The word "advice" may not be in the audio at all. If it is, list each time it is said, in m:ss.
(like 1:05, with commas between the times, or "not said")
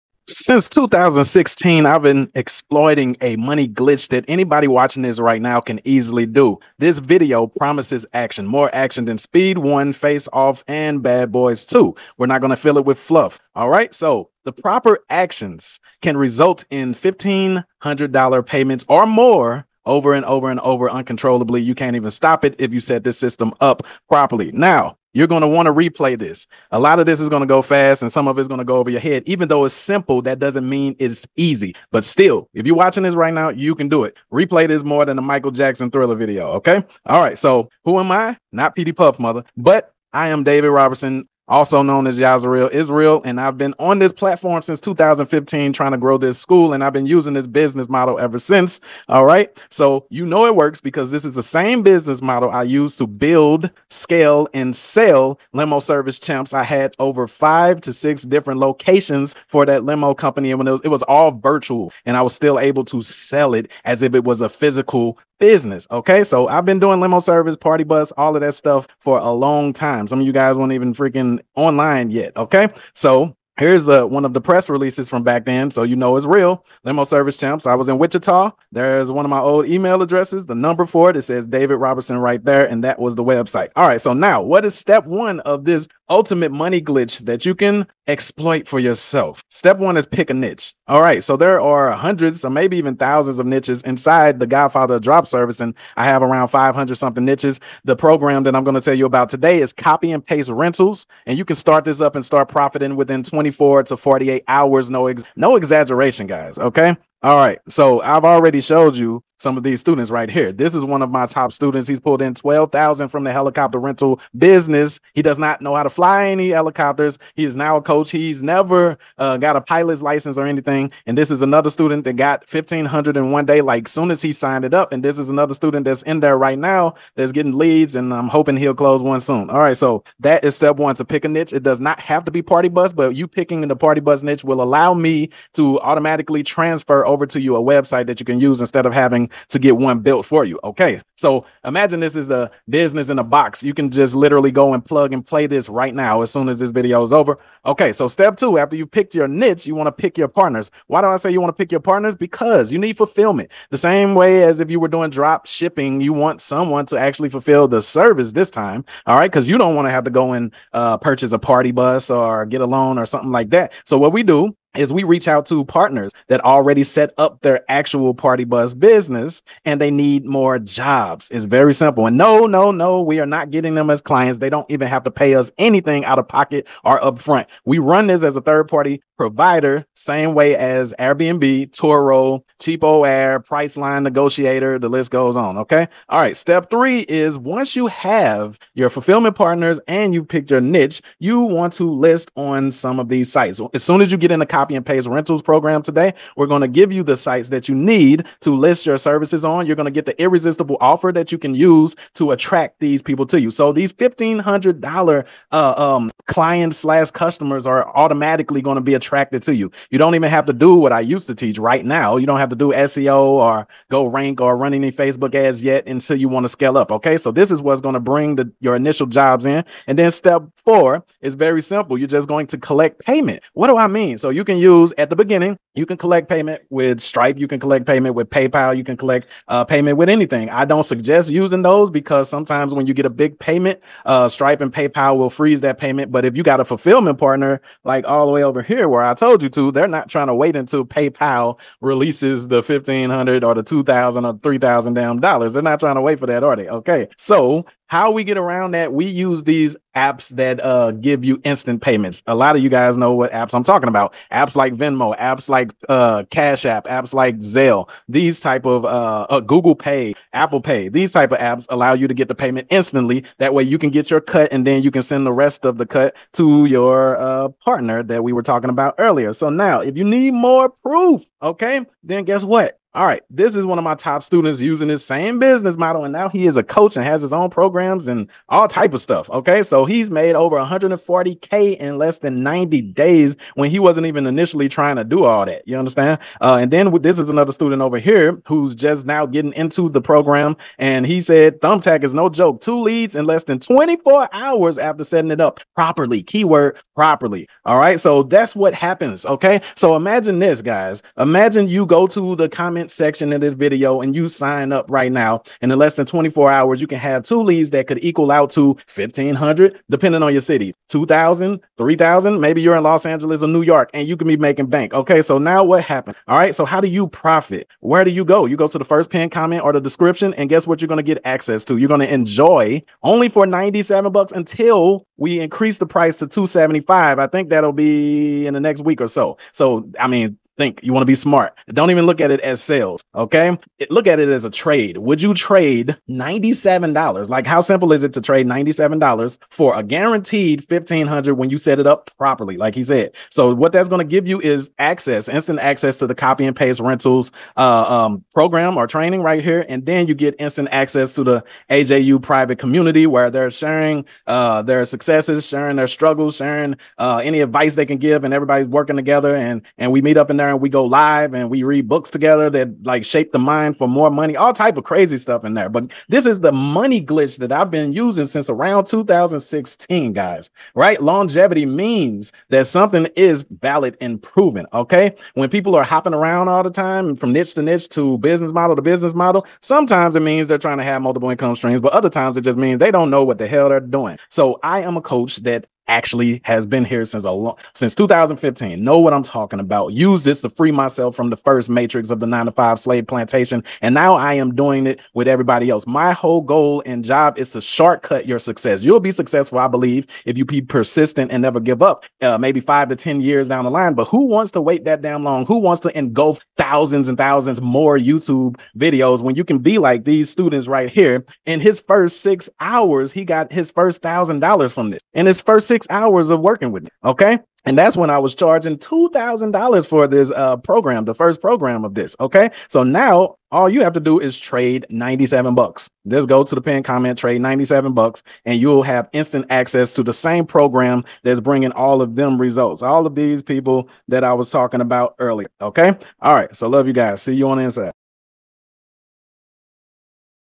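5:57.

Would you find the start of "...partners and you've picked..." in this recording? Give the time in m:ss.
3:09.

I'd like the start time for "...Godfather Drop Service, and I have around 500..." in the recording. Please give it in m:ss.
1:34.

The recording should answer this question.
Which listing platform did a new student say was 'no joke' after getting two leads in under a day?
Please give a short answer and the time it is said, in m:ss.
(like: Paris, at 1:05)
Thumbtack, at 4:51.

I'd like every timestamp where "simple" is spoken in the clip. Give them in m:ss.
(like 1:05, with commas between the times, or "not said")
0:29, 2:51, 3:41, 5:37.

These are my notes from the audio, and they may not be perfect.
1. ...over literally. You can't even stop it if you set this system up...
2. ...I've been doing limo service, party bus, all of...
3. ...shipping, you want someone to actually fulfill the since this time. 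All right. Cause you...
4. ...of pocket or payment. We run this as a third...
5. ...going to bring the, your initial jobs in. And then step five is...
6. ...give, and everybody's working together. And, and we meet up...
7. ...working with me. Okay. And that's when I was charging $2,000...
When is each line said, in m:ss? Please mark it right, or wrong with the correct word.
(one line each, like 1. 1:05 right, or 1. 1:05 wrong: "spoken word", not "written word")
1. 0:20 wrong: "uncontrollably", not "literally"
2. 1:06 right
3. 2:35 wrong: "service", not "since"
4. 2:56 wrong: "upfront", not "payment"
5. 3:37 wrong: "four", not "five"
6. 5:57 right
7. 6:56 right.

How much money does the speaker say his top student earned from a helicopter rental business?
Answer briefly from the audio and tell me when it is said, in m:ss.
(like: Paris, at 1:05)
12,000, at 1:52.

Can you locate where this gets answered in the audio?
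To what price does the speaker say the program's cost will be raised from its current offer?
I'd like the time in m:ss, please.
5:26.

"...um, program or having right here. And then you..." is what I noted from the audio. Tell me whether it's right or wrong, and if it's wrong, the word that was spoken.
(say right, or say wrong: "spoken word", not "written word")
wrong: "training", not "having".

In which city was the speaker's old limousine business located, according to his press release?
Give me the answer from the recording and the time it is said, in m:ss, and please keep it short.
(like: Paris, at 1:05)
Wichita, at 1:17.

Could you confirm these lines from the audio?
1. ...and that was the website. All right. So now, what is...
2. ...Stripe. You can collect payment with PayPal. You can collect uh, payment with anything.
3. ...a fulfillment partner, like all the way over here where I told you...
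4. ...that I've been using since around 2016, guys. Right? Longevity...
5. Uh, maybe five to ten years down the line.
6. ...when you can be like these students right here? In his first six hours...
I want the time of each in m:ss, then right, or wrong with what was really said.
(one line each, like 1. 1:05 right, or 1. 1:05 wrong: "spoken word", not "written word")
1. 1:22 right
2. 3:46 right
3. 3:56 right
4. 6:07 right
5. 6:42 right
6. 6:49 right.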